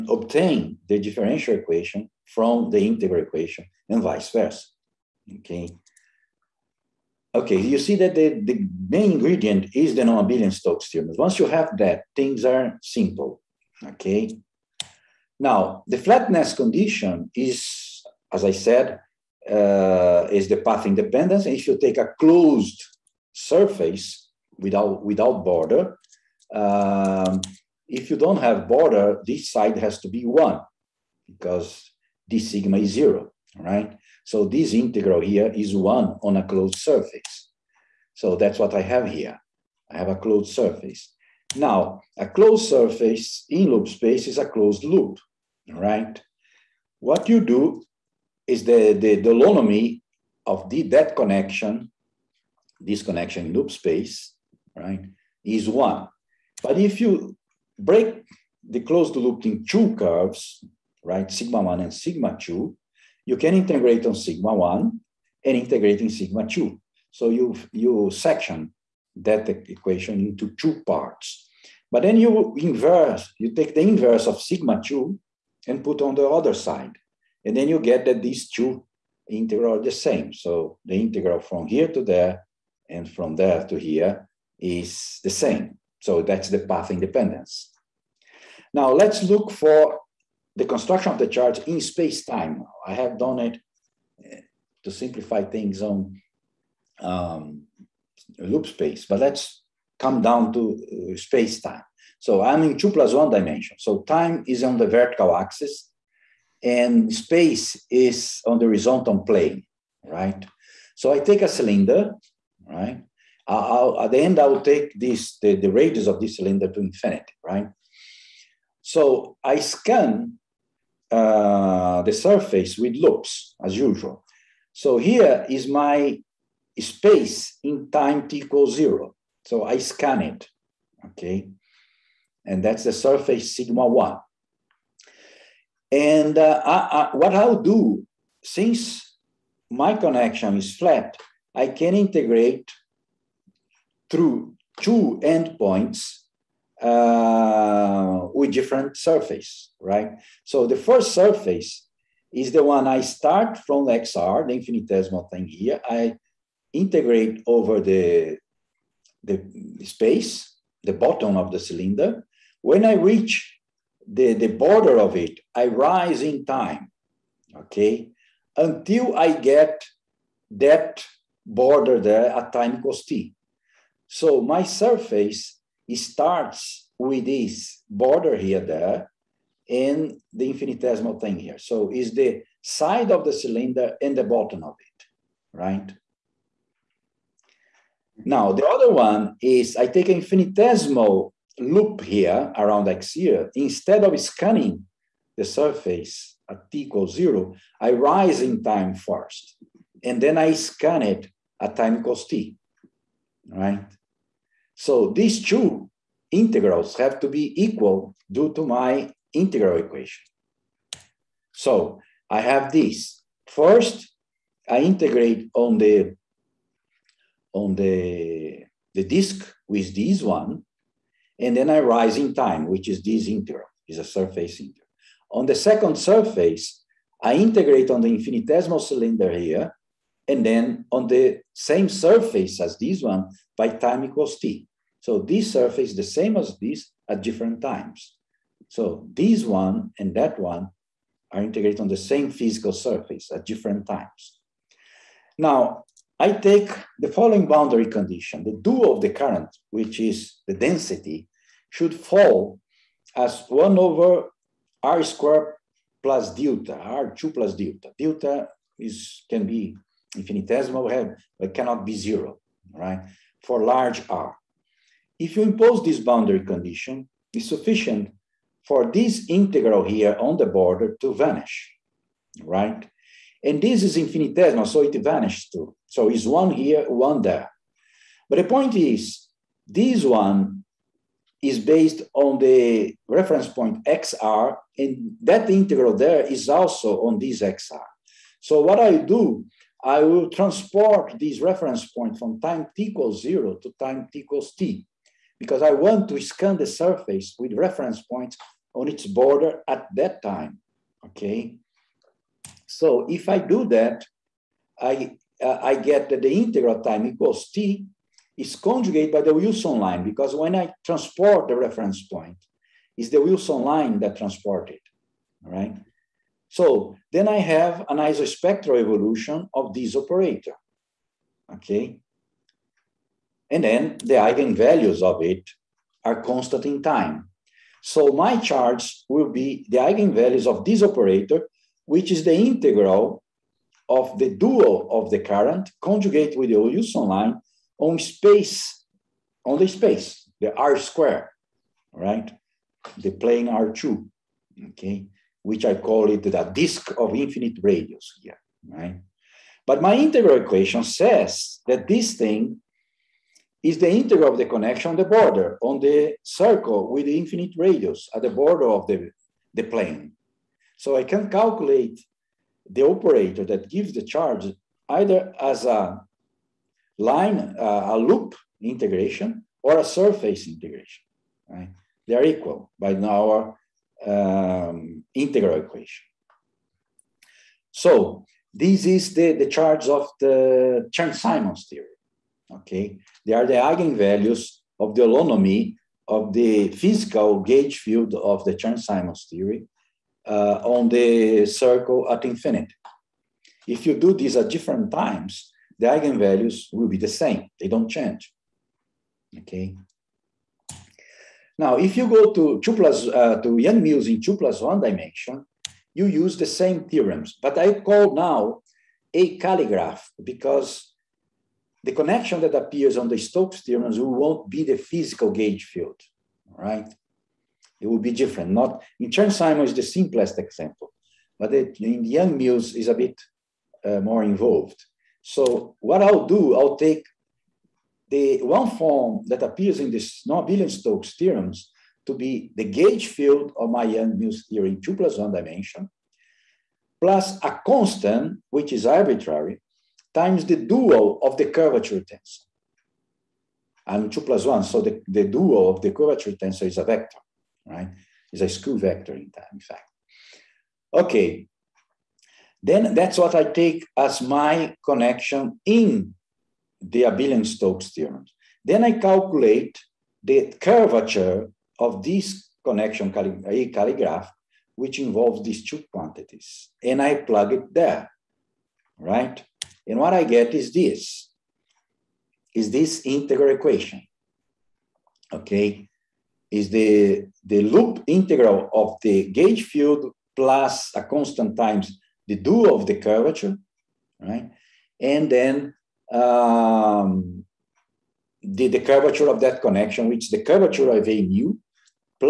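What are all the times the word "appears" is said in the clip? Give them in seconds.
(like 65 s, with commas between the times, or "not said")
412 s, 429 s.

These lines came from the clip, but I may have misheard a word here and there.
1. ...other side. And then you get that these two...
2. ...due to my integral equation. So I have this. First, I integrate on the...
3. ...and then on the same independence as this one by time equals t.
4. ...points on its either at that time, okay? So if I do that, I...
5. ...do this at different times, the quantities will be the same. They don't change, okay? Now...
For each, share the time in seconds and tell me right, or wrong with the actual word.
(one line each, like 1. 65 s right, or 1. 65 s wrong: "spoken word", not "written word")
1. 76 s right
2. 208 s right
3. 230 s wrong: "surface", not "independence"
4. 298 s wrong: "border", not "either"
5. 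393 s wrong: "eigenvalues", not "quantities".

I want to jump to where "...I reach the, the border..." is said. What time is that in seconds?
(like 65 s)
162 s.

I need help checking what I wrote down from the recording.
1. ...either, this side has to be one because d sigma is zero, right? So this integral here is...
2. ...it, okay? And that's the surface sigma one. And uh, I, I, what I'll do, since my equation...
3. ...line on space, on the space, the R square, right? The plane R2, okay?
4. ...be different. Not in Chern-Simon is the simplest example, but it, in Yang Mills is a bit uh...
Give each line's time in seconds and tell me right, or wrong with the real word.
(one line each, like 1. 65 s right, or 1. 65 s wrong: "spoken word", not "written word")
1. 28 s wrong: "border", not "either"
2. 130 s wrong: "connection", not "equation"
3. 337 s right
4. 417 s right.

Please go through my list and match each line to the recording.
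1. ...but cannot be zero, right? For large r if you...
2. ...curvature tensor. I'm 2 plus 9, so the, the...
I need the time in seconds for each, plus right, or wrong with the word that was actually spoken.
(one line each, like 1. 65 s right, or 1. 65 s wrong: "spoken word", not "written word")
1. 261 s right
2. 441 s wrong: "1", not "9".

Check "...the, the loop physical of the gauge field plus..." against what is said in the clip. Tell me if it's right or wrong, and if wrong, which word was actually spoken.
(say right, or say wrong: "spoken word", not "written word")
wrong: "integral", not "physical".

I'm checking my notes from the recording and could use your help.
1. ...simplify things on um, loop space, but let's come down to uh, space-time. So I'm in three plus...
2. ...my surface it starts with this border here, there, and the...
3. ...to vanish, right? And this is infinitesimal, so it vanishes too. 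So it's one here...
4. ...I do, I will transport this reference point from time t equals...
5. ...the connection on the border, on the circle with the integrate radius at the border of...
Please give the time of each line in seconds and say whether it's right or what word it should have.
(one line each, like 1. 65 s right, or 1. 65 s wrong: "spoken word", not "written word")
1. 94 s wrong: "two", not "three"
2. 174 s right
3. 271 s right
4. 288 s right
5. 354 s wrong: "infinite", not "integrate".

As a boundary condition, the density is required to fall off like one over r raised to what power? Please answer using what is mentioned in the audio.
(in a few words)
2 plus delta.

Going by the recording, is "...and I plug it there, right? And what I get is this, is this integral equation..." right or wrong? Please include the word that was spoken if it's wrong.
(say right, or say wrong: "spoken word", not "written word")
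right.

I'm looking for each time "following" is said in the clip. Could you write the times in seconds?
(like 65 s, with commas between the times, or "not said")
247 s.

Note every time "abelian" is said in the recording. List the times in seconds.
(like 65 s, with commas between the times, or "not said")
10 s, 430 s, 457 s.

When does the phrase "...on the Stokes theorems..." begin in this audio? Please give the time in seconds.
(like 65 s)
412 s.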